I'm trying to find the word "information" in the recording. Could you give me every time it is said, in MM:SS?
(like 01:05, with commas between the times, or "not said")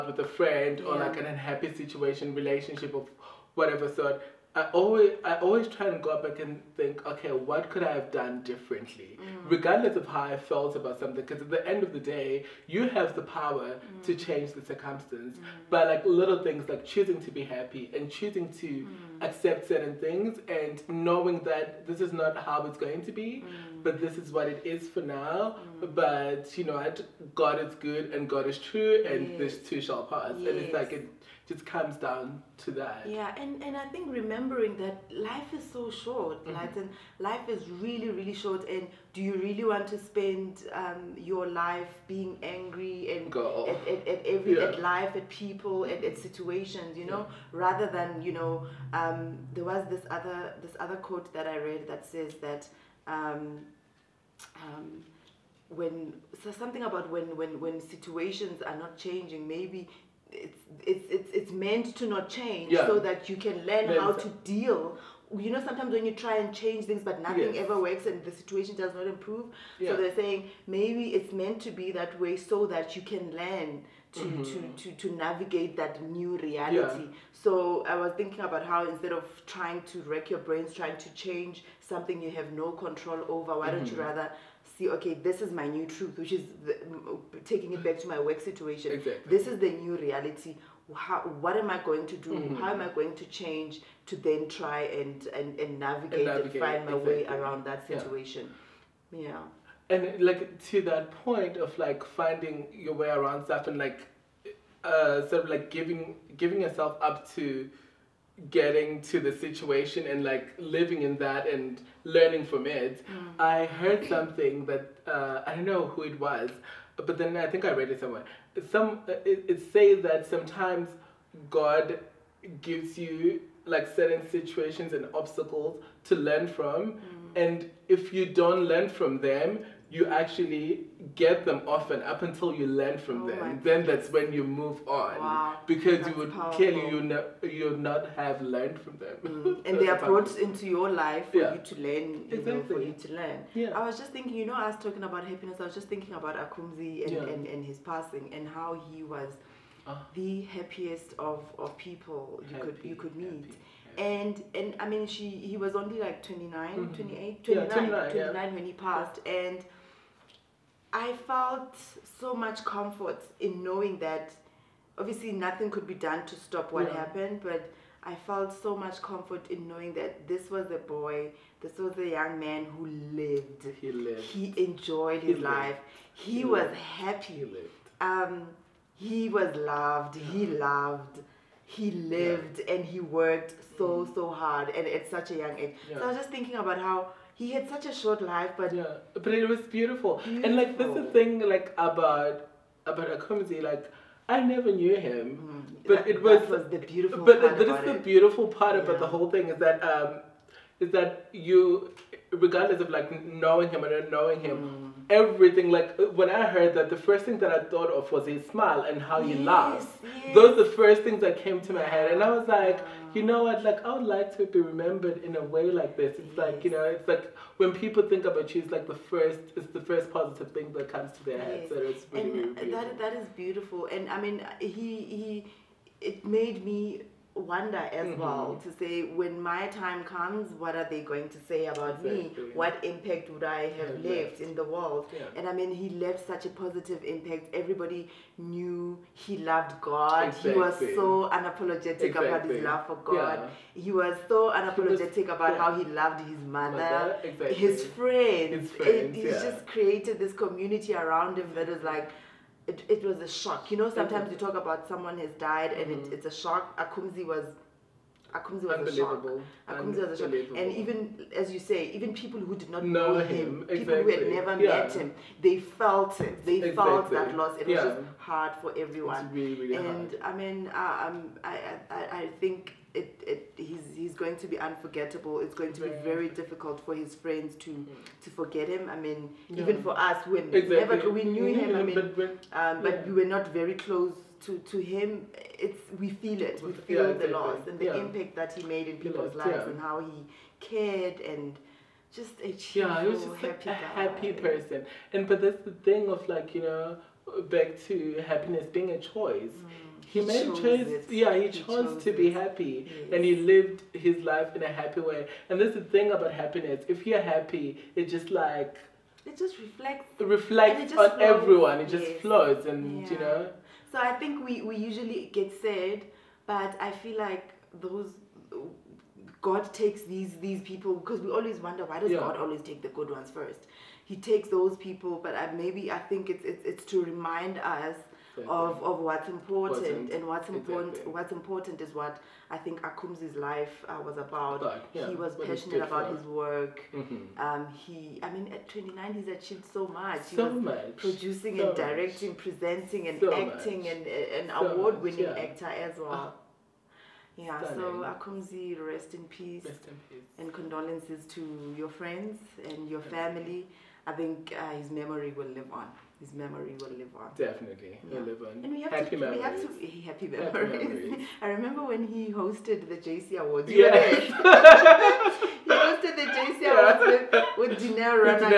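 not said.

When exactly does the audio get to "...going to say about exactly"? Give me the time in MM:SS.
03:51.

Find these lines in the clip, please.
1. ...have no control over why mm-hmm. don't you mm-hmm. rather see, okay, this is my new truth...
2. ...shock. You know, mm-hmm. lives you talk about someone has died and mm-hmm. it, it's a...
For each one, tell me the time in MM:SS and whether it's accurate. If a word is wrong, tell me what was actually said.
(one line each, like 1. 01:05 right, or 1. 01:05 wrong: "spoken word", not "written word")
1. 01:22 right
2. 04:13 wrong: "sometimes", not "lives".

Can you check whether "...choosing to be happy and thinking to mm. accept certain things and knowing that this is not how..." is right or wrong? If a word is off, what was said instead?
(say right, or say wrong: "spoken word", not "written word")
wrong: "choosing", not "thinking".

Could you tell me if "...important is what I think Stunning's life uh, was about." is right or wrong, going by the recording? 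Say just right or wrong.
wrong.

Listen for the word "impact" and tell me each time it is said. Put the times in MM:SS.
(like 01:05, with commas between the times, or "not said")
03:52, 03:57, 04:47.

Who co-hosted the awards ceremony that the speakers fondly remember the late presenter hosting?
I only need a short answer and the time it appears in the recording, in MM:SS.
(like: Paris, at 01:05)
Dineo, at 06:07.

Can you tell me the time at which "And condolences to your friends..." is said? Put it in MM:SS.
05:50.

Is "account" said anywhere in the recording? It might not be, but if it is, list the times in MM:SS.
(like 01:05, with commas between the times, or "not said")
not said.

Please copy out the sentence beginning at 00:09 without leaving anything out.
regardless of how I felt about something.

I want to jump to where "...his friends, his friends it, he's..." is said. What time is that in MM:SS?
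04:07.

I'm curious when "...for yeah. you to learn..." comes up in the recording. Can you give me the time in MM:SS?
02:21.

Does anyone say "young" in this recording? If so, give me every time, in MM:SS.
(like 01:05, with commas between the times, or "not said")
02:52, 03:05.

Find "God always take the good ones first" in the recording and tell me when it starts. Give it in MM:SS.
05:22.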